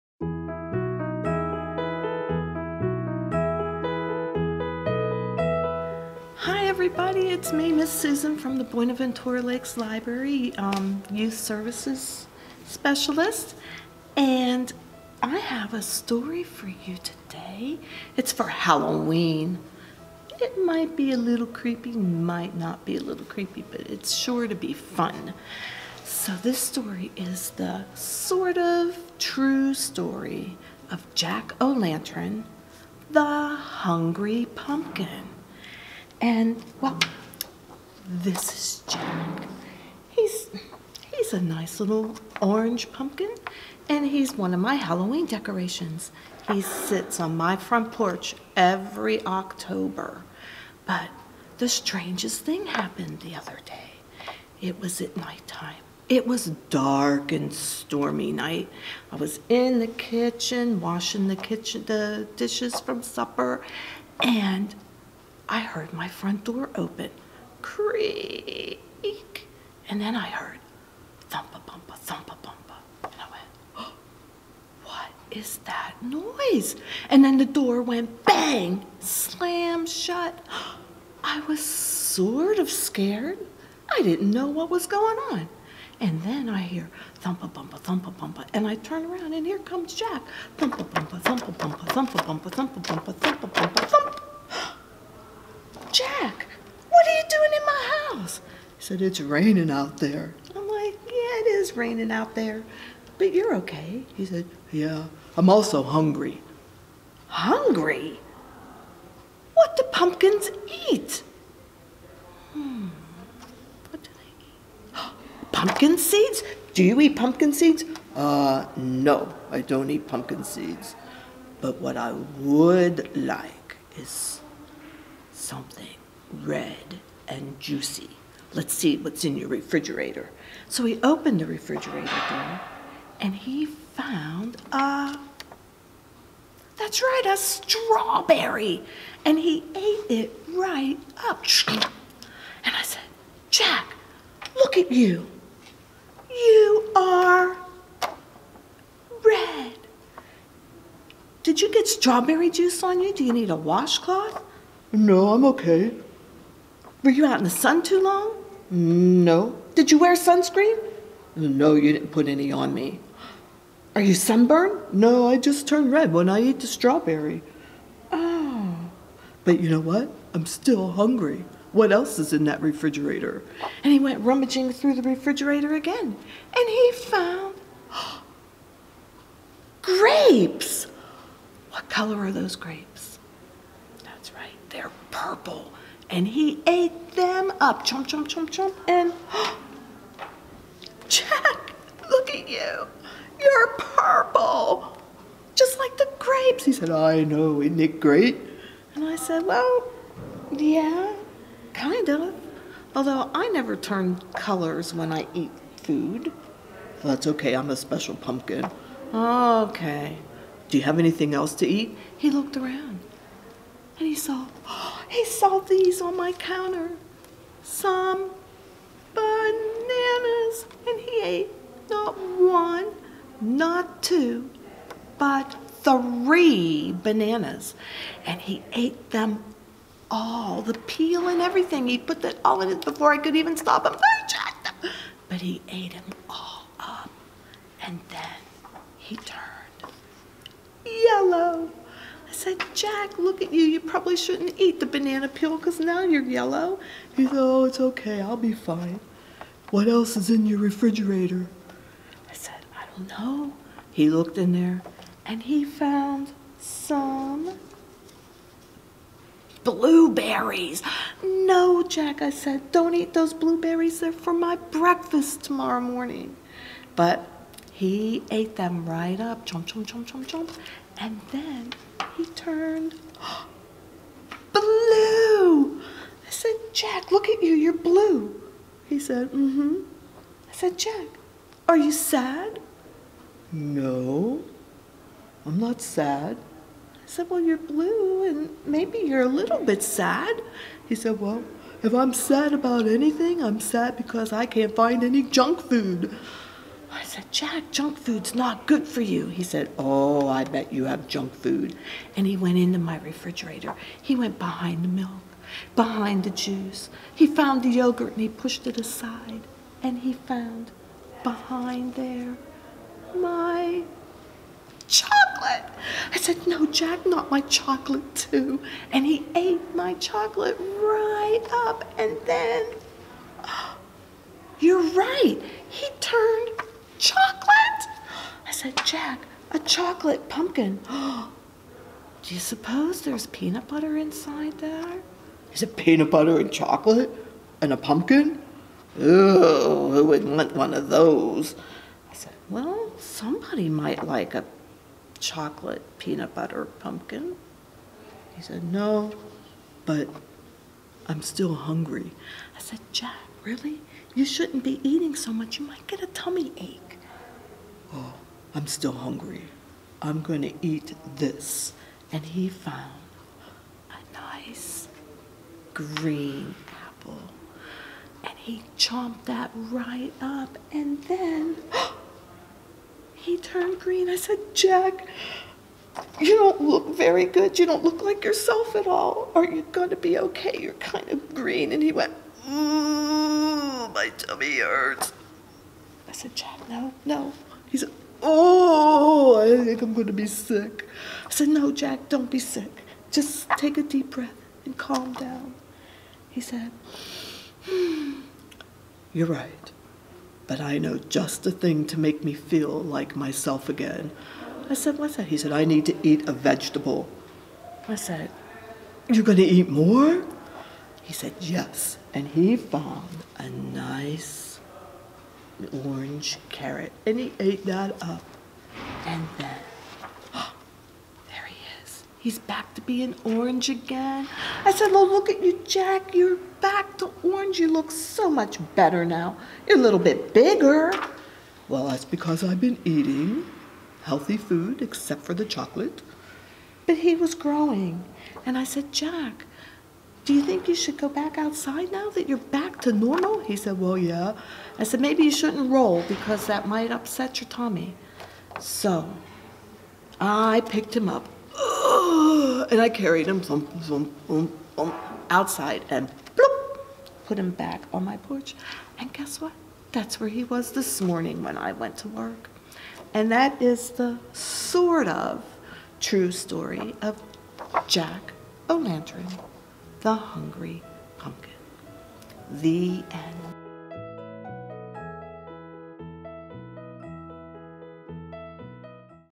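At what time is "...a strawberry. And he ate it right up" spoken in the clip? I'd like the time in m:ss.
2:17.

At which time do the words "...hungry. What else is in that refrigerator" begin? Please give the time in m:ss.
2:50.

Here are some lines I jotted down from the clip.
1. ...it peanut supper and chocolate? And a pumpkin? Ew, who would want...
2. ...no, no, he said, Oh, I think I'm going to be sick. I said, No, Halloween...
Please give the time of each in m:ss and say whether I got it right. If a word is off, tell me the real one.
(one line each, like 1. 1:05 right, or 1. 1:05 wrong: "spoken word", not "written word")
1. 5:35 wrong: "butter", not "supper"
2. 6:26 wrong: "Jack", not "Halloween".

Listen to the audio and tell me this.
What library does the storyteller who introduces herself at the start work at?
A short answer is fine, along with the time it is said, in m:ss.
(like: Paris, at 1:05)
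Buenaventura Lakes Library, at 0:08.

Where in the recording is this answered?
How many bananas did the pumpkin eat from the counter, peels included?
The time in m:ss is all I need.
3:45.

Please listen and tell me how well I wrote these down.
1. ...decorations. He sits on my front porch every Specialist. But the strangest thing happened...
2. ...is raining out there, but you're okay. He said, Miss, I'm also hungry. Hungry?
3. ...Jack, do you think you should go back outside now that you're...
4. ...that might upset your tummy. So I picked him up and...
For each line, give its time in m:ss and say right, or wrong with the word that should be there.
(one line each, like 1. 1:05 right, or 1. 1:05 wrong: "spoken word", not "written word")
1. 0:45 wrong: "October", not "Specialist"
2. 1:41 wrong: "Yeah", not "Miss"
3. 7:18 right
4. 7:26 right.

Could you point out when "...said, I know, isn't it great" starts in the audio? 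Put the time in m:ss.
3:16.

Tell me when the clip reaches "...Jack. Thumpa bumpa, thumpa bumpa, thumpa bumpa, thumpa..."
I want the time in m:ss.
1:29.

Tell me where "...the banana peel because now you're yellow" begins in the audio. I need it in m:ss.
4:04.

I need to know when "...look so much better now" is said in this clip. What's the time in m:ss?
7:07.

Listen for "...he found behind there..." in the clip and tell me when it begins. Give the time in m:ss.
5:09.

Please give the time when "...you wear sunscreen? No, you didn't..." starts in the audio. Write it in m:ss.
2:39.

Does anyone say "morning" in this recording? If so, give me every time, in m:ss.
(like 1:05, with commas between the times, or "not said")
4:25, 7:41.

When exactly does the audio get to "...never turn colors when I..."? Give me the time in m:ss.
3:23.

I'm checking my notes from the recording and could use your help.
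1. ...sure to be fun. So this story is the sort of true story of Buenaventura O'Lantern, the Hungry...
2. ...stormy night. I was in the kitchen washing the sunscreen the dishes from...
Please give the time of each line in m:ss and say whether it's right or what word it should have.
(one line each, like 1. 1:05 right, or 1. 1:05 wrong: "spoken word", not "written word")
1. 0:24 wrong: "Jack", not "Buenaventura"
2. 0:57 wrong: "kitchen", not "sunscreen".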